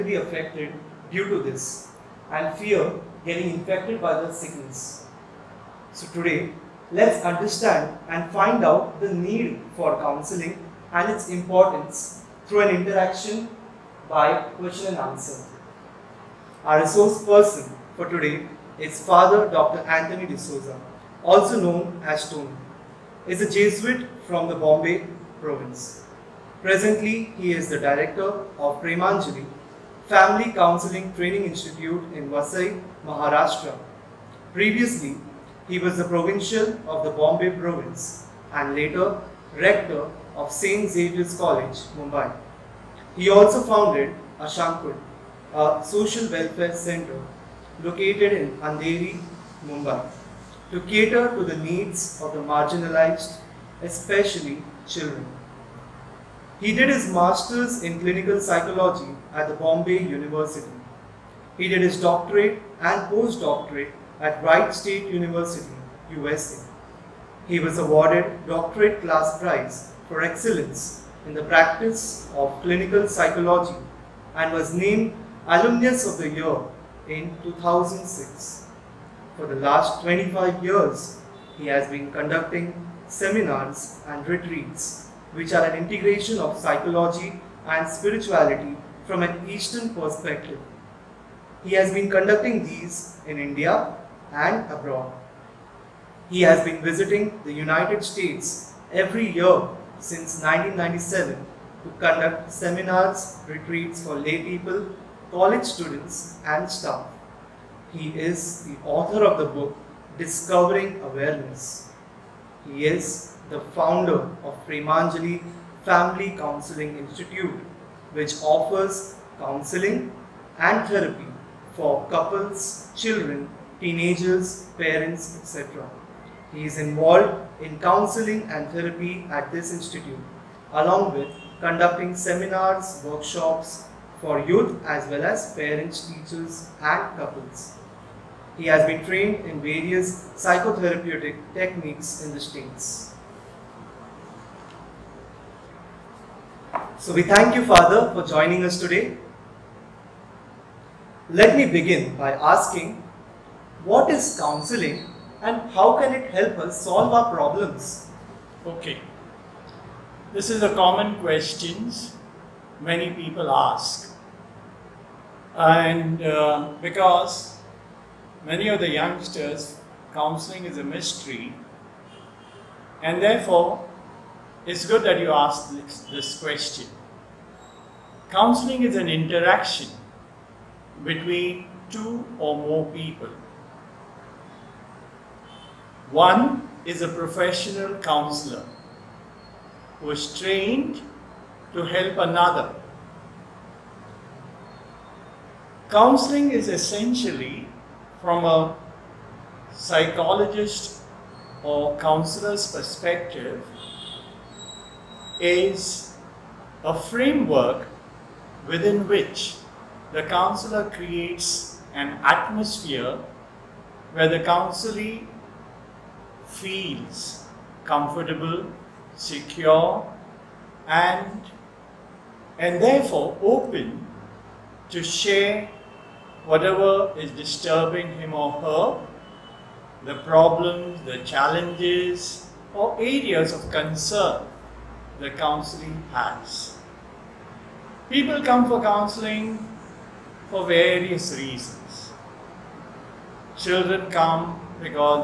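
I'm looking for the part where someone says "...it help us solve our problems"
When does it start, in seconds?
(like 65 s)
156 s.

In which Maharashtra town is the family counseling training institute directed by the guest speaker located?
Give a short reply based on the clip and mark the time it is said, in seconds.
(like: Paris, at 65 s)
Vasai, at 32 s.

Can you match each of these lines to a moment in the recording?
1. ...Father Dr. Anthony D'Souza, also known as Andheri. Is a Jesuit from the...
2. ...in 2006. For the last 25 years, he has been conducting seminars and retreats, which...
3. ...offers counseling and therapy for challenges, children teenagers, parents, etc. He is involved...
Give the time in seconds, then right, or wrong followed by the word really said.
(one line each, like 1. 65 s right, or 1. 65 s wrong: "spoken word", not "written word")
1. 19 s wrong: "Tony", not "Andheri"
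2. 77 s right
3. 118 s wrong: "couples", not "challenges".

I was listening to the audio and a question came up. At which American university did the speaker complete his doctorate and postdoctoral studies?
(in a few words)
Wright State University.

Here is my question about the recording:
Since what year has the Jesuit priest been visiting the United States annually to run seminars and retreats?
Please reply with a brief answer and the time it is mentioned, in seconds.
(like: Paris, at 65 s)
1997, at 100 s.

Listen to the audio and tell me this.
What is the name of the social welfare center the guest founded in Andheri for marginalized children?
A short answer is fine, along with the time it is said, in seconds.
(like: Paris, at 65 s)
Ashankul, at 44 s.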